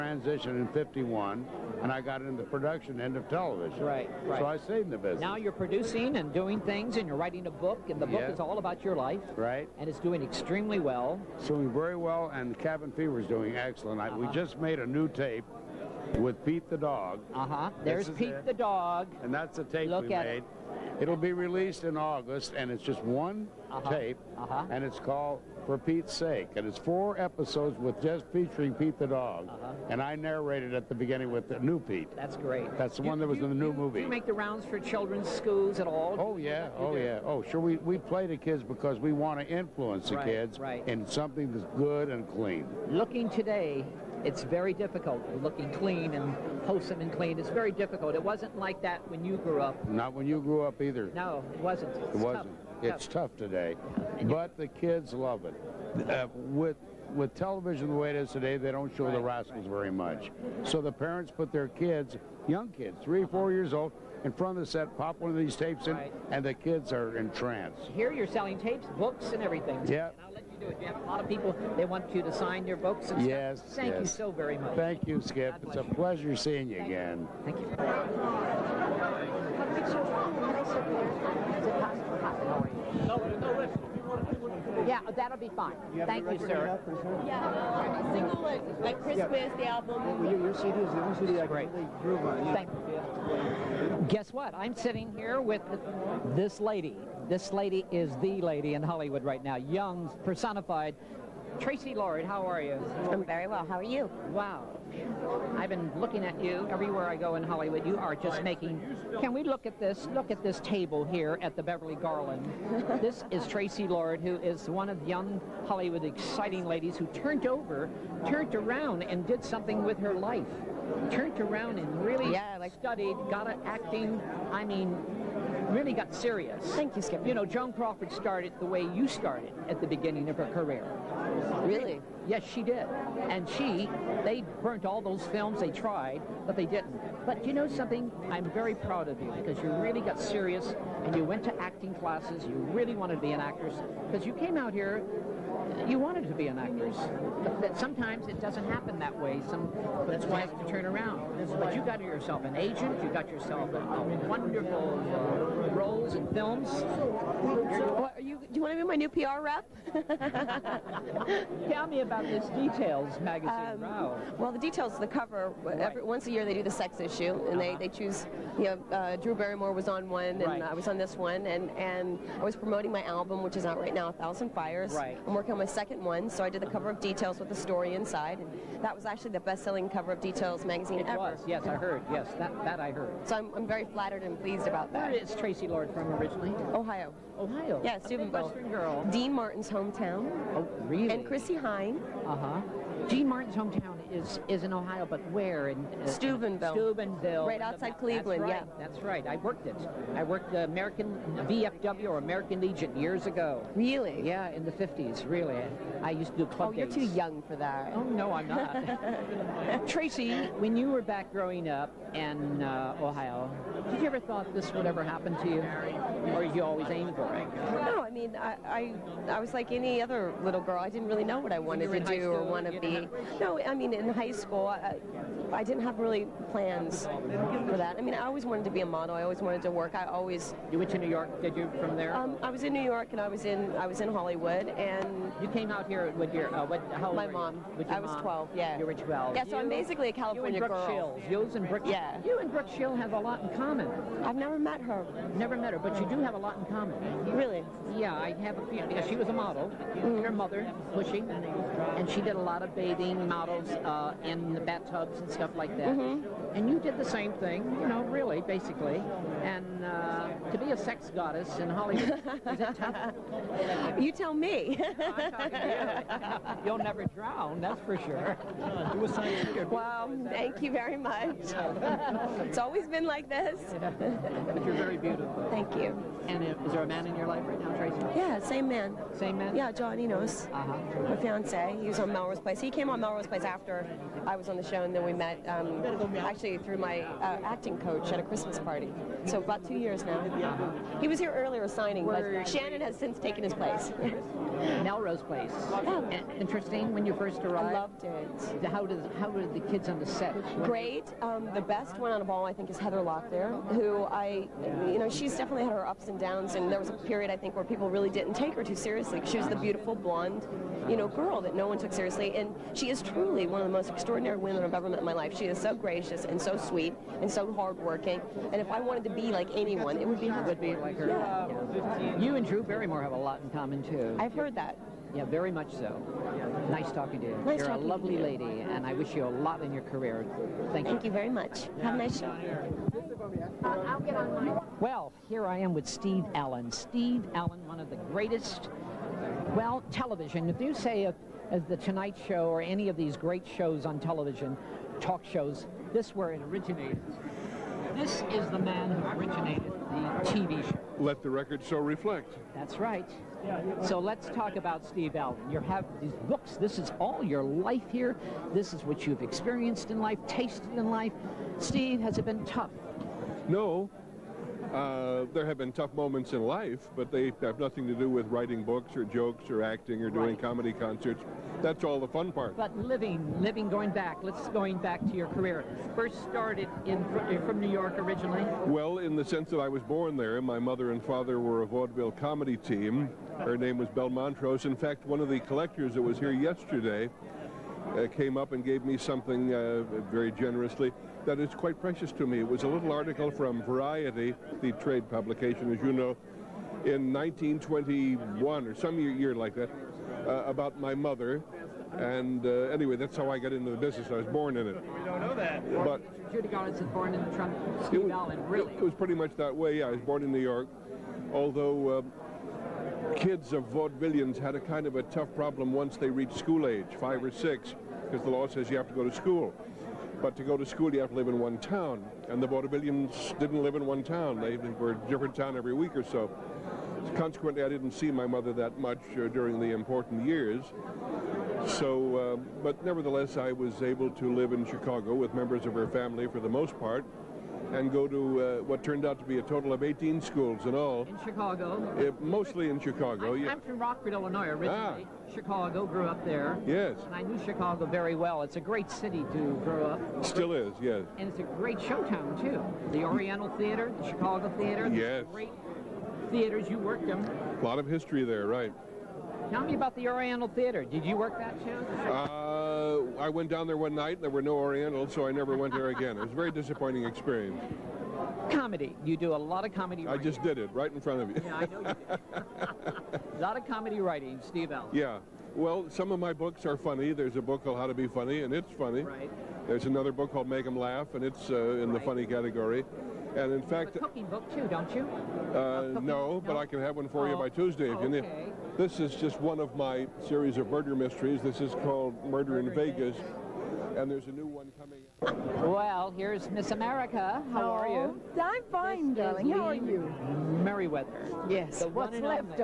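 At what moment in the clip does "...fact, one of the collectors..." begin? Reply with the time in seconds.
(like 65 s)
384 s.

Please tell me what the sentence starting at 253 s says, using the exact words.
Uh, uh, in the bathtubs and stuff like that.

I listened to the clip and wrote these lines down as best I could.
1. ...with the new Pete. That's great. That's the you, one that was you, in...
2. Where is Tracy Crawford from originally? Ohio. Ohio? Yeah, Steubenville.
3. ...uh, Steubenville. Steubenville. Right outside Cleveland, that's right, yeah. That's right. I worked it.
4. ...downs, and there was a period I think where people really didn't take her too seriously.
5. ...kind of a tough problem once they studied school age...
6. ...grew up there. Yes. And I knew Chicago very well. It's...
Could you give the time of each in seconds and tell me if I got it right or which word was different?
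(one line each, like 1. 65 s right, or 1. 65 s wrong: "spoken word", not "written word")
1. 31 s right
2. 185 s wrong: "Lords", not "Crawford"
3. 195 s right
4. 306 s right
5. 414 s wrong: "reached", not "studied"
6. 445 s right.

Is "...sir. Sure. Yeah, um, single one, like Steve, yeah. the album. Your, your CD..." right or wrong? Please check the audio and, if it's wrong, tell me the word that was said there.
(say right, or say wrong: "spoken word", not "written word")
wrong: "Christmas", not "Steve".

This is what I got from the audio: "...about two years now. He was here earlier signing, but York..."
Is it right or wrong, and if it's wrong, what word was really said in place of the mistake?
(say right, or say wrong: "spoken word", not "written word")
wrong: "Shannon", not "York".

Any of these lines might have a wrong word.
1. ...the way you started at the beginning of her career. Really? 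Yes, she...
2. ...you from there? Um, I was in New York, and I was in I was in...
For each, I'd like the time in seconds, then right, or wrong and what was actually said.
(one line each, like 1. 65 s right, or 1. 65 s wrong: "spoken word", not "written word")
1. 128 s right
2. 231 s right.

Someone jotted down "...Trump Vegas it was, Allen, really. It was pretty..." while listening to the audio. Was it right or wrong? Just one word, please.
wrong.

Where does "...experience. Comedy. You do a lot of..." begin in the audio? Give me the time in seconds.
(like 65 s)
467 s.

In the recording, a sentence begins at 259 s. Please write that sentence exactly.
And uh, to be a sex goddess in Hollywood, is tough?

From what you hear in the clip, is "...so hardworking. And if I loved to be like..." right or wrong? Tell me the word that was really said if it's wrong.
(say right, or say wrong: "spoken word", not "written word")
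wrong: "wanted", not "loved".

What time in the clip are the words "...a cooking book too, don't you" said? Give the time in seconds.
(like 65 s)
484 s.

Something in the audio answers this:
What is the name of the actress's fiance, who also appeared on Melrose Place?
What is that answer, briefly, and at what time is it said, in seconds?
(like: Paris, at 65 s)
John Enos, at 279 s.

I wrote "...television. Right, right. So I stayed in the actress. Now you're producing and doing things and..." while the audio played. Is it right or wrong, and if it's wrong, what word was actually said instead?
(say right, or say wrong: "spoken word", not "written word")
wrong: "business", not "actress".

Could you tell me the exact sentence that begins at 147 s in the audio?
That sometimes it doesn't happen that way.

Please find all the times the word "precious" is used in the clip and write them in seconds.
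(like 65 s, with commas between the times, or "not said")
391 s.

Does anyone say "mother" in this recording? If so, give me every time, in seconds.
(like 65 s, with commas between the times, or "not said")
250 s, 380 s, 400 s, 428 s.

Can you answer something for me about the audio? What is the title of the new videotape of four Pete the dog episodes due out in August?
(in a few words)
For Pete's Sake.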